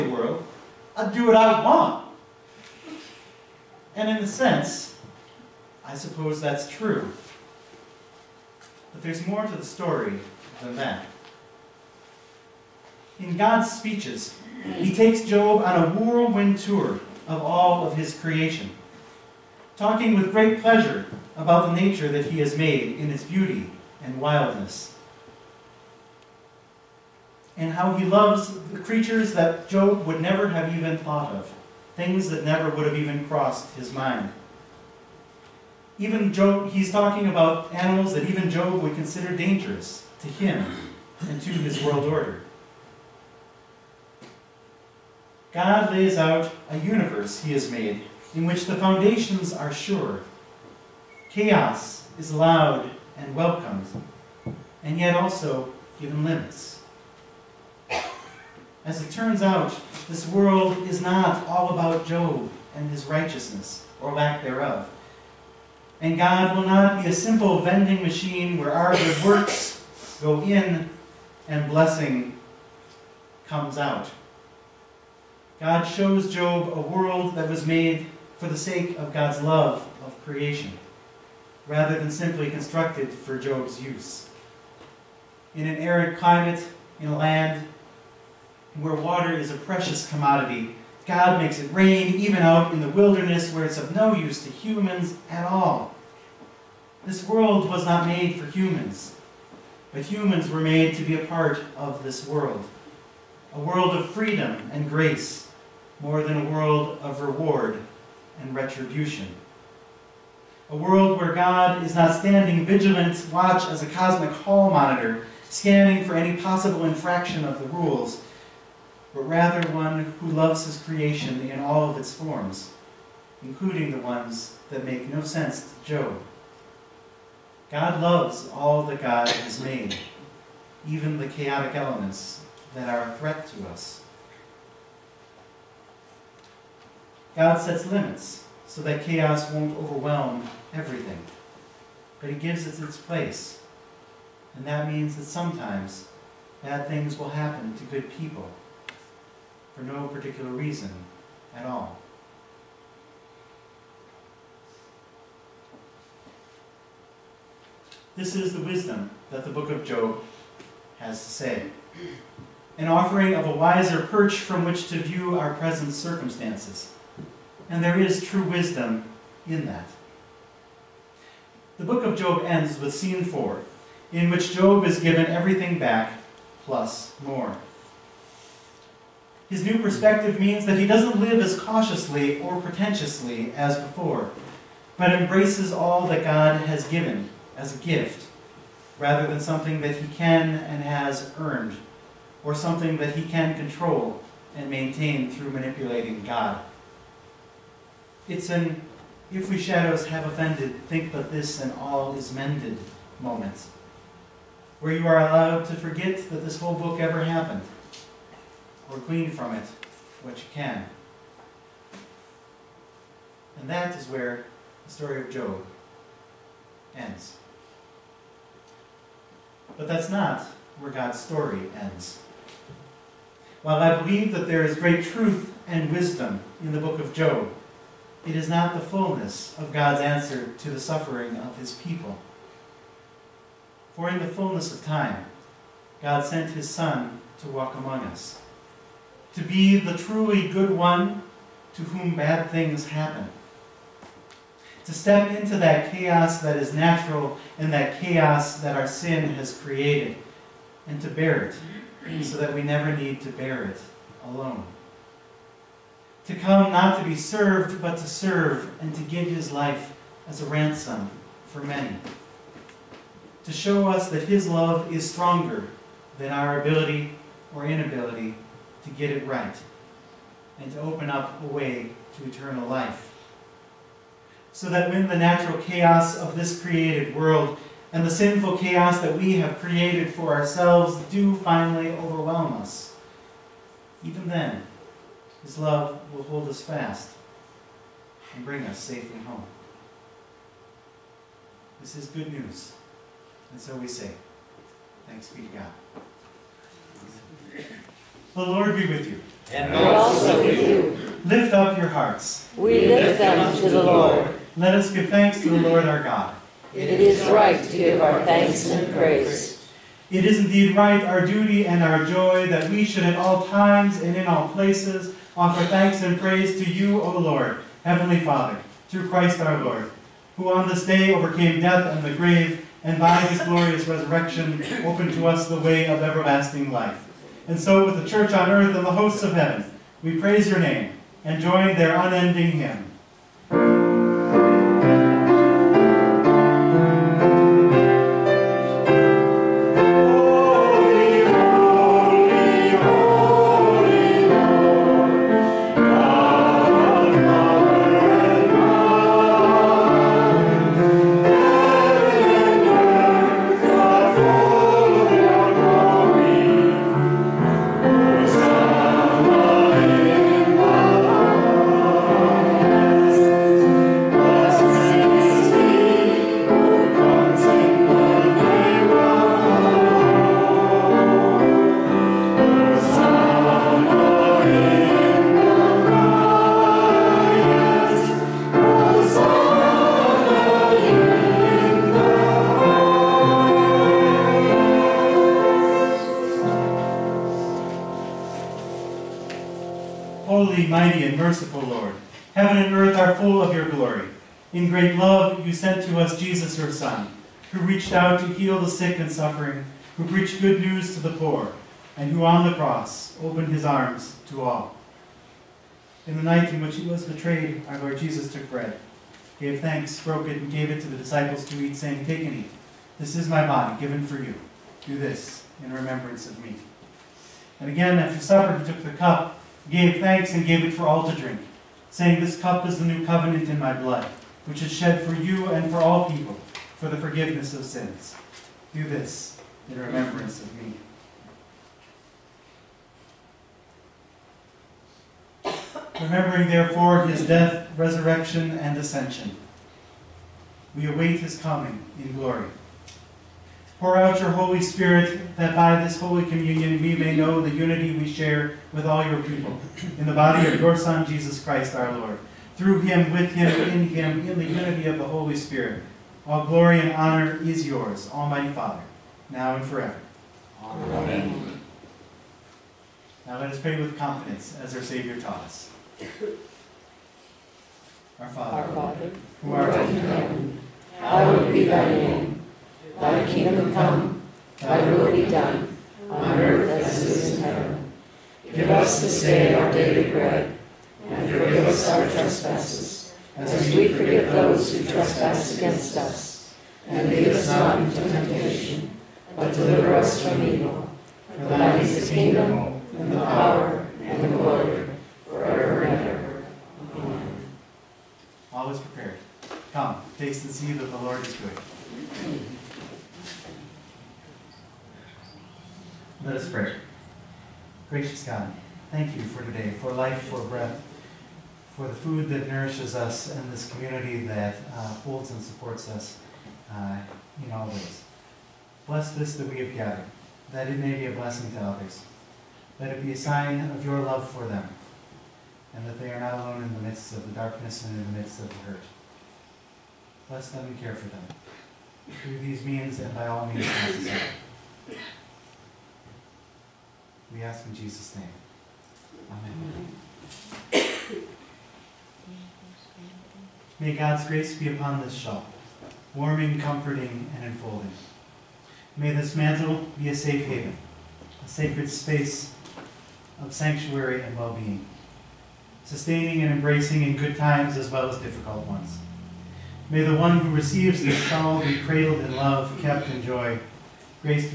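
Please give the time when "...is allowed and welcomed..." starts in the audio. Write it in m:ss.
0:52.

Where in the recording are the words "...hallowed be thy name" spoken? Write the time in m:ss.
7:50.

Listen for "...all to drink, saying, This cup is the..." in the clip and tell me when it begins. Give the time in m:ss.
7:00.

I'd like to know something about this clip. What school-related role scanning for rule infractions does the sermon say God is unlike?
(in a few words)
cosmic hall monitor.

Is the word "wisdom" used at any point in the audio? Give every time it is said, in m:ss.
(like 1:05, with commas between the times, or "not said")
2:38, 2:48, 3:45.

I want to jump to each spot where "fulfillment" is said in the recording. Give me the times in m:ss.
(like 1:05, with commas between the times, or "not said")
not said.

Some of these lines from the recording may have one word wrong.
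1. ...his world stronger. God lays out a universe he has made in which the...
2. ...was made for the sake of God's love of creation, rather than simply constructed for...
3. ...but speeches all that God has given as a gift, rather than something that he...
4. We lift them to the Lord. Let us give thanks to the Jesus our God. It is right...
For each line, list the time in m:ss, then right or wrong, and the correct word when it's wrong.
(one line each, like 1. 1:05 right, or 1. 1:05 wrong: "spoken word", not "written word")
1. 0:41 wrong: "order", not "stronger"
2. 1:17 right
3. 3:04 wrong: "embraces", not "speeches"
4. 5:02 wrong: "Lord", not "Jesus".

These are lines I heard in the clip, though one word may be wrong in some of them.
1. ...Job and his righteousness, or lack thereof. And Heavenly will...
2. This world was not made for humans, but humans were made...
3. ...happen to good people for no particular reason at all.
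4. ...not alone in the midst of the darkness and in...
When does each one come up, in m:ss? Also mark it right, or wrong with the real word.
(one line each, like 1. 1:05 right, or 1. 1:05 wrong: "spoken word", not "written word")
1. 1:02 wrong: "God", not "Heavenly"
2. 1:37 right
3. 2:27 right
4. 8:46 right.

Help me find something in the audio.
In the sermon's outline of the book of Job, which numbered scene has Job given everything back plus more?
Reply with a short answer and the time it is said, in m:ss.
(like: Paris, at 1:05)
scene four, at 2:52.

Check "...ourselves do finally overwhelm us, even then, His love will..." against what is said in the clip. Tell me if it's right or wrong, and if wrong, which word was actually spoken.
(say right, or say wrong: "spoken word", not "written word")
right.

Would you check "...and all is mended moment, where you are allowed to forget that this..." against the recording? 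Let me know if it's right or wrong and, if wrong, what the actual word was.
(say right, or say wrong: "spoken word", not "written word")
right.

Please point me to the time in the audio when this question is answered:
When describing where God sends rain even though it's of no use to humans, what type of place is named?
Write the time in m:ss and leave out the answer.
1:32.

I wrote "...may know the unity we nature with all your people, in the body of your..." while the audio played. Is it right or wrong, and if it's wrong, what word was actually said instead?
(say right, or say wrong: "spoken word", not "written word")
wrong: "share", not "nature".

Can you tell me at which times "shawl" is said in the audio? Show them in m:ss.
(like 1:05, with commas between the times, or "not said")
9:05, 9:21.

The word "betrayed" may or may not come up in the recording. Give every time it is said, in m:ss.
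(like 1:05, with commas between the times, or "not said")
6:47.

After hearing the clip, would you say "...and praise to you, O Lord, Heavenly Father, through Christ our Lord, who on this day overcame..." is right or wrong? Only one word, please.
right.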